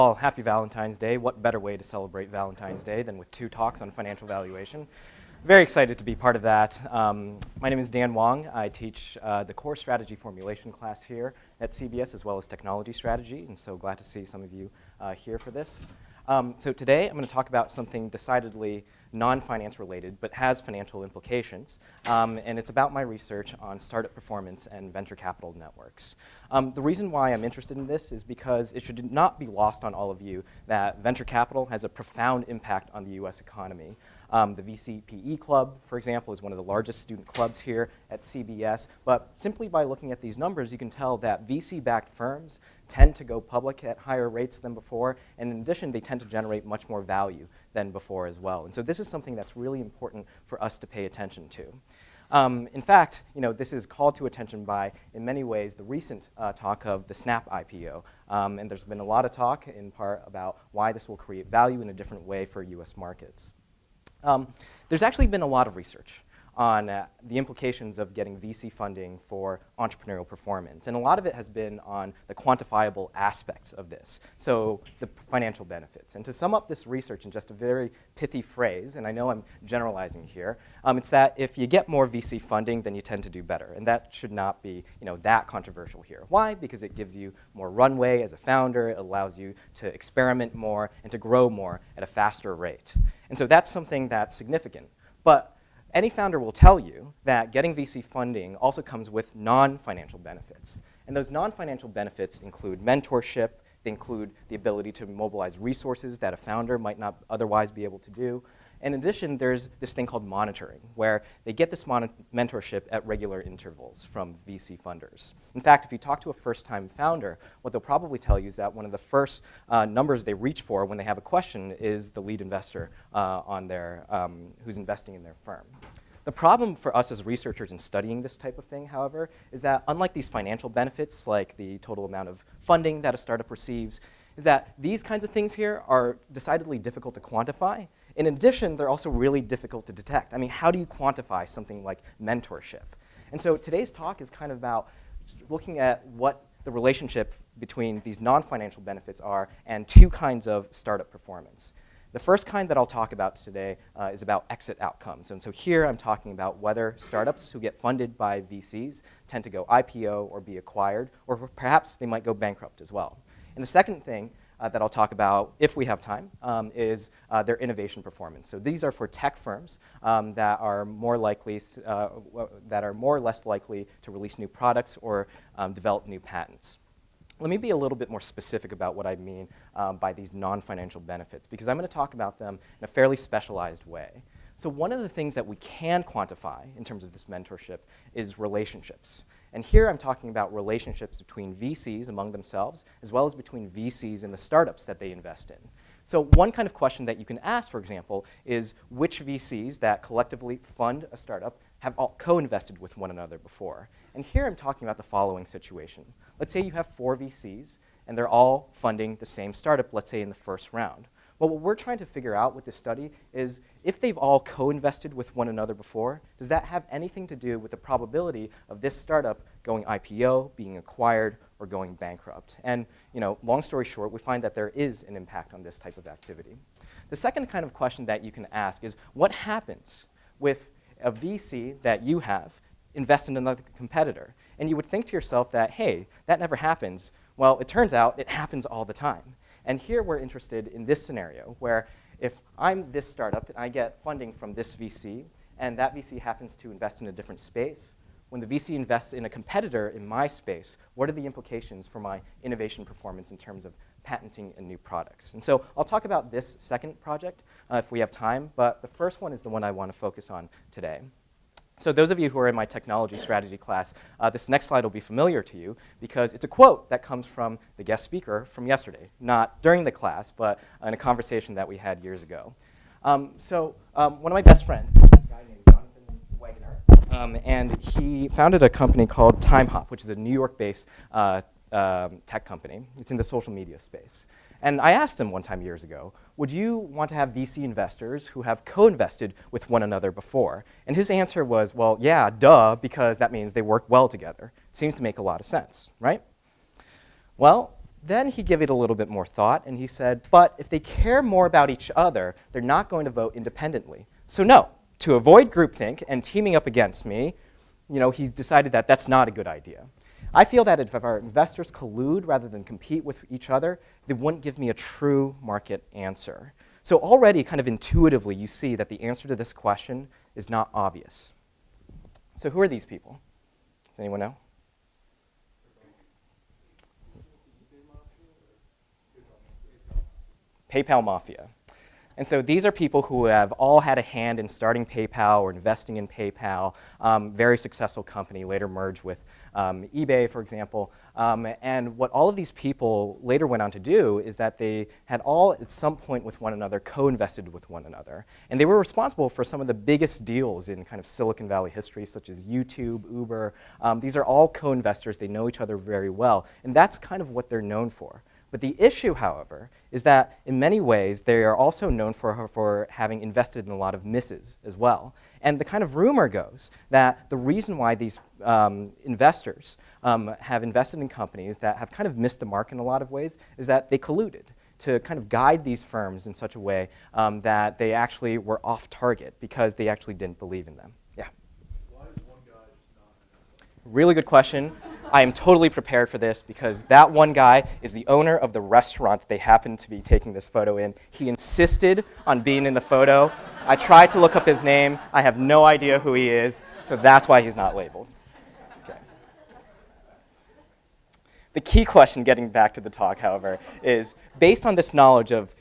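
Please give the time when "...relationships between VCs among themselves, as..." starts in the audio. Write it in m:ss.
3:10.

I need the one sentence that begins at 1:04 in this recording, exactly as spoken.
Um, there's actually been a lot of research on uh, the implications of getting VC funding for entrepreneurial performance.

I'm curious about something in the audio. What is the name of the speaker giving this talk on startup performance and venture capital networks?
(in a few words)
Dan Wang.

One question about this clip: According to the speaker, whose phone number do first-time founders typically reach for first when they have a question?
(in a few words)
the lead investor.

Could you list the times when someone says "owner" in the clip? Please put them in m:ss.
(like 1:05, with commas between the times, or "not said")
6:28.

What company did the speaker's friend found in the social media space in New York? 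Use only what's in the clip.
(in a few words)
TimeHop.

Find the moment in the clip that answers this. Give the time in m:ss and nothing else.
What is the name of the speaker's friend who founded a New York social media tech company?
4:35.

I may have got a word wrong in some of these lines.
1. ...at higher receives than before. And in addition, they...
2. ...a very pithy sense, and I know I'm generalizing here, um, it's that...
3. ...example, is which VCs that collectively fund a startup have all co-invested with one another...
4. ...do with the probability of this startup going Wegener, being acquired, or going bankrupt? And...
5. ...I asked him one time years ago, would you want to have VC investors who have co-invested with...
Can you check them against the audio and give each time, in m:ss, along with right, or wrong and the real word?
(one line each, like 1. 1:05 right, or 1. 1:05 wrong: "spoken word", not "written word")
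1. 0:43 wrong: "rates", not "receives"
2. 1:17 wrong: "phrase", not "sense"
3. 3:17 right
4. 3:37 wrong: "IPO", not "Wegener"
5. 4:44 right.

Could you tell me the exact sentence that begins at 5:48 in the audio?
And they were responsible for some of the biggest deals in kind of Silicon Valley history, such as YouTube, Uber.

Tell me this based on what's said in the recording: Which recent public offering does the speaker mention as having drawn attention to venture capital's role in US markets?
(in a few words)
Snap.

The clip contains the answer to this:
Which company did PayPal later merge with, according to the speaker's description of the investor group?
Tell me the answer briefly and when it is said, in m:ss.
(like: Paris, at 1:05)
eBay, at 5:39.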